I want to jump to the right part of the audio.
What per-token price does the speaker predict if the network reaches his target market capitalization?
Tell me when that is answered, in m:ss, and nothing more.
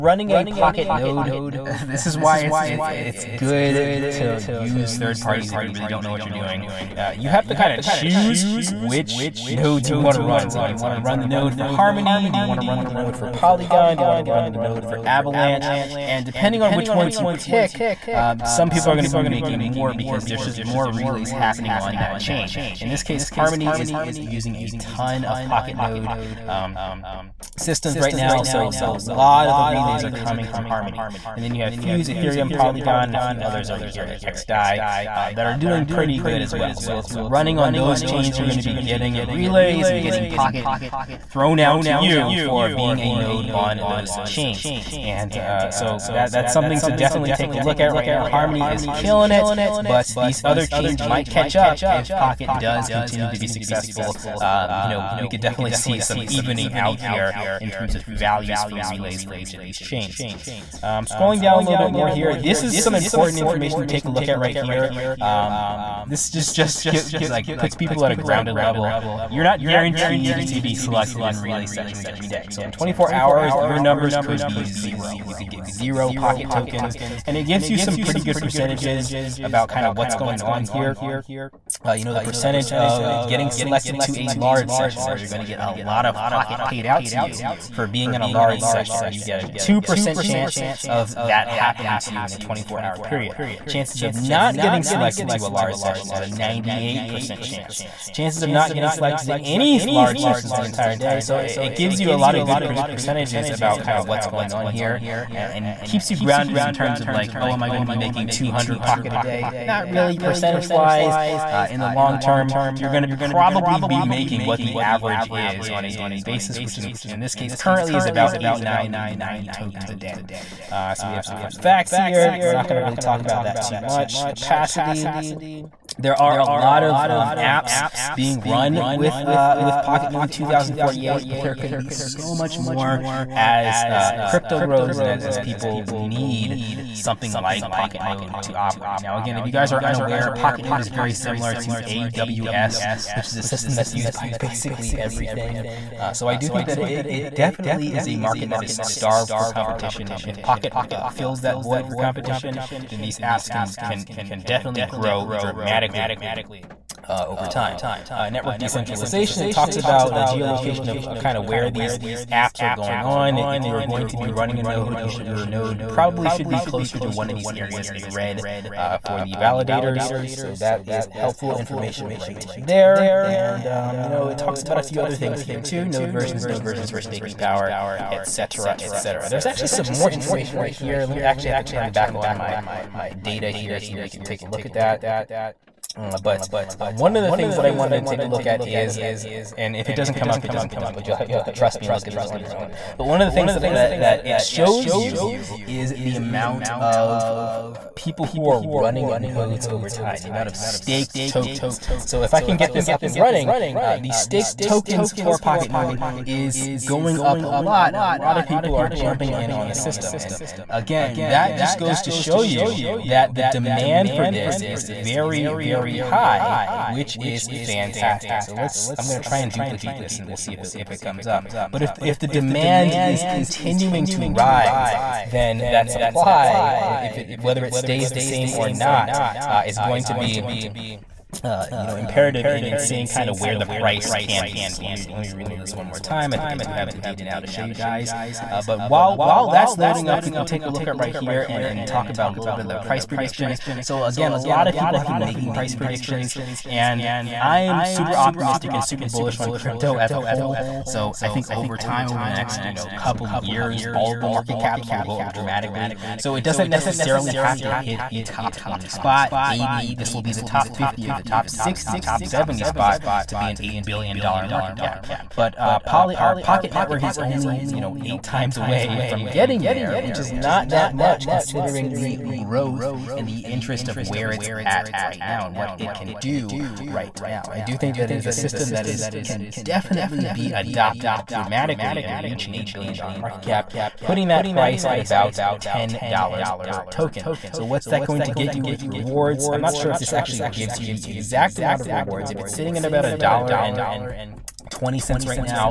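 4:45.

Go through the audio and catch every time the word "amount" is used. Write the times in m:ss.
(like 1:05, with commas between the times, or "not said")
3:16, 3:20, 4:51.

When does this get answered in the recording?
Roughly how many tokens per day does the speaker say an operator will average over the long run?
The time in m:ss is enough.
1:58.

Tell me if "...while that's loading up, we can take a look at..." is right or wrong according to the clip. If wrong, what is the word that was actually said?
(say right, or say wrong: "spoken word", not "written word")
right.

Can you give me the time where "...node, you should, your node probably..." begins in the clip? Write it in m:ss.
2:44.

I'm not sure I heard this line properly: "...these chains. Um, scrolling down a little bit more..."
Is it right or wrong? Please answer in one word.
right.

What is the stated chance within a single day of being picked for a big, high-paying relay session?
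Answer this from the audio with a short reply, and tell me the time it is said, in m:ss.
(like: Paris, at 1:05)
2%, at 1:29.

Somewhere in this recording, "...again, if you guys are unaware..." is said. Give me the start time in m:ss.
2:19.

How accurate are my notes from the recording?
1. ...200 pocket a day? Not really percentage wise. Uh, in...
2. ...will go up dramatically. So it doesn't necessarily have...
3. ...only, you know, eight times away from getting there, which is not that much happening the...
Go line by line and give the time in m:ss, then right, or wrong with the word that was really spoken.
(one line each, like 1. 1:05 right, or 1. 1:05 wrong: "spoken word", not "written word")
1. 1:48 right
2. 4:14 right
3. 4:27 wrong: "considering", not "happening".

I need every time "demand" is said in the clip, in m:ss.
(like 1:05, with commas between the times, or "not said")
3:33, 3:42.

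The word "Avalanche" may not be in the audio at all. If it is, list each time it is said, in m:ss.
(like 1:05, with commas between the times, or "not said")
0:15.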